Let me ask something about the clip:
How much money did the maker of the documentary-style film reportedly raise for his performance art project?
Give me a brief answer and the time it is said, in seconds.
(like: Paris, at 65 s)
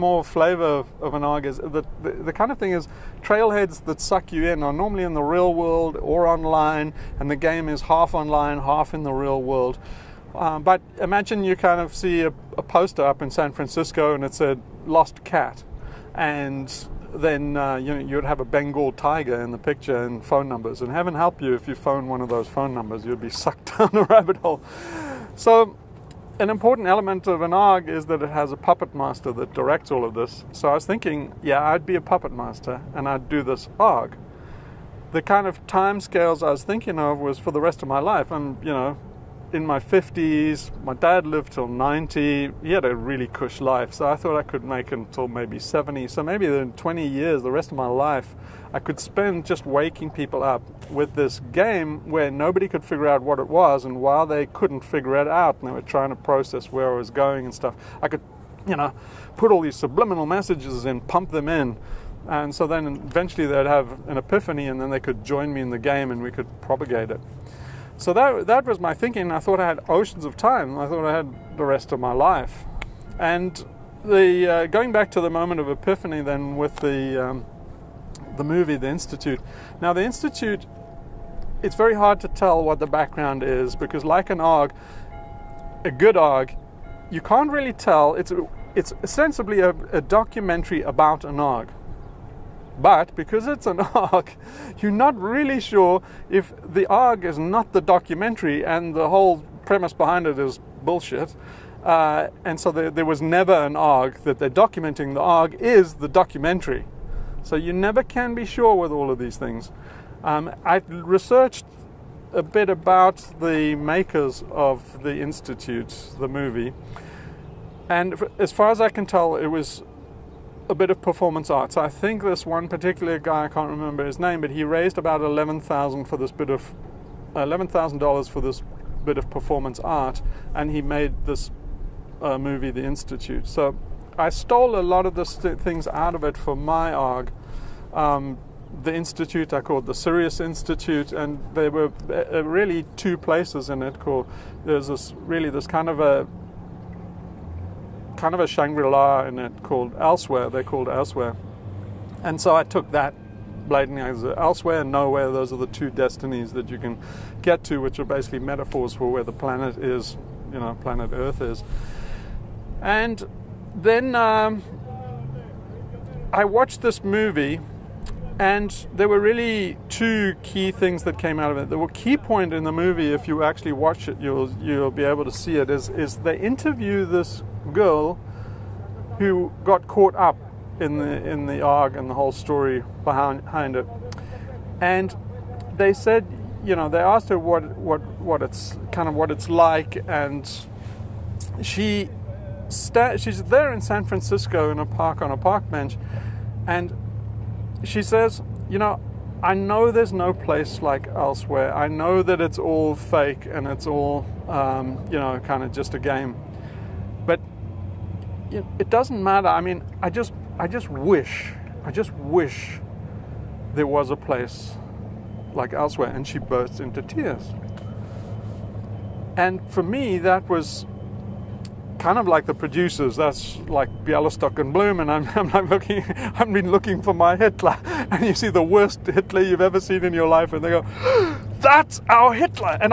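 $11,000, at 127 s.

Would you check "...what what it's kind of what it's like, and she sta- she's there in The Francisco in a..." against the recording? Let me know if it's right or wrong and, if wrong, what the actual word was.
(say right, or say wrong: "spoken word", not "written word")
wrong: "San", not "The".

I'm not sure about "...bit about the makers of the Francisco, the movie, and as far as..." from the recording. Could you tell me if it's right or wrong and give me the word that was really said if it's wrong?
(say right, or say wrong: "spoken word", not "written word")
wrong: "Institute", not "Francisco".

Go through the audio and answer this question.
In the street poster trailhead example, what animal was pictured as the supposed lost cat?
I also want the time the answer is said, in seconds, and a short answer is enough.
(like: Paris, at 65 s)
Bengal tiger, at 18 s.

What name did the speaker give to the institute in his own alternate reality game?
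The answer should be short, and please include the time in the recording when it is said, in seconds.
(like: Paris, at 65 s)
Sirius Institute, at 139 s.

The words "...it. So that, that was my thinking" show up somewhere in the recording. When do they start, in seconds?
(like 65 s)
67 s.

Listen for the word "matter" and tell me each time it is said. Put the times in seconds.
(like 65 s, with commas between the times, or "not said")
209 s.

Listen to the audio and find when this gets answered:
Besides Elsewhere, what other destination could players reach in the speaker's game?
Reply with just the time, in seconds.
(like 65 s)
154 s.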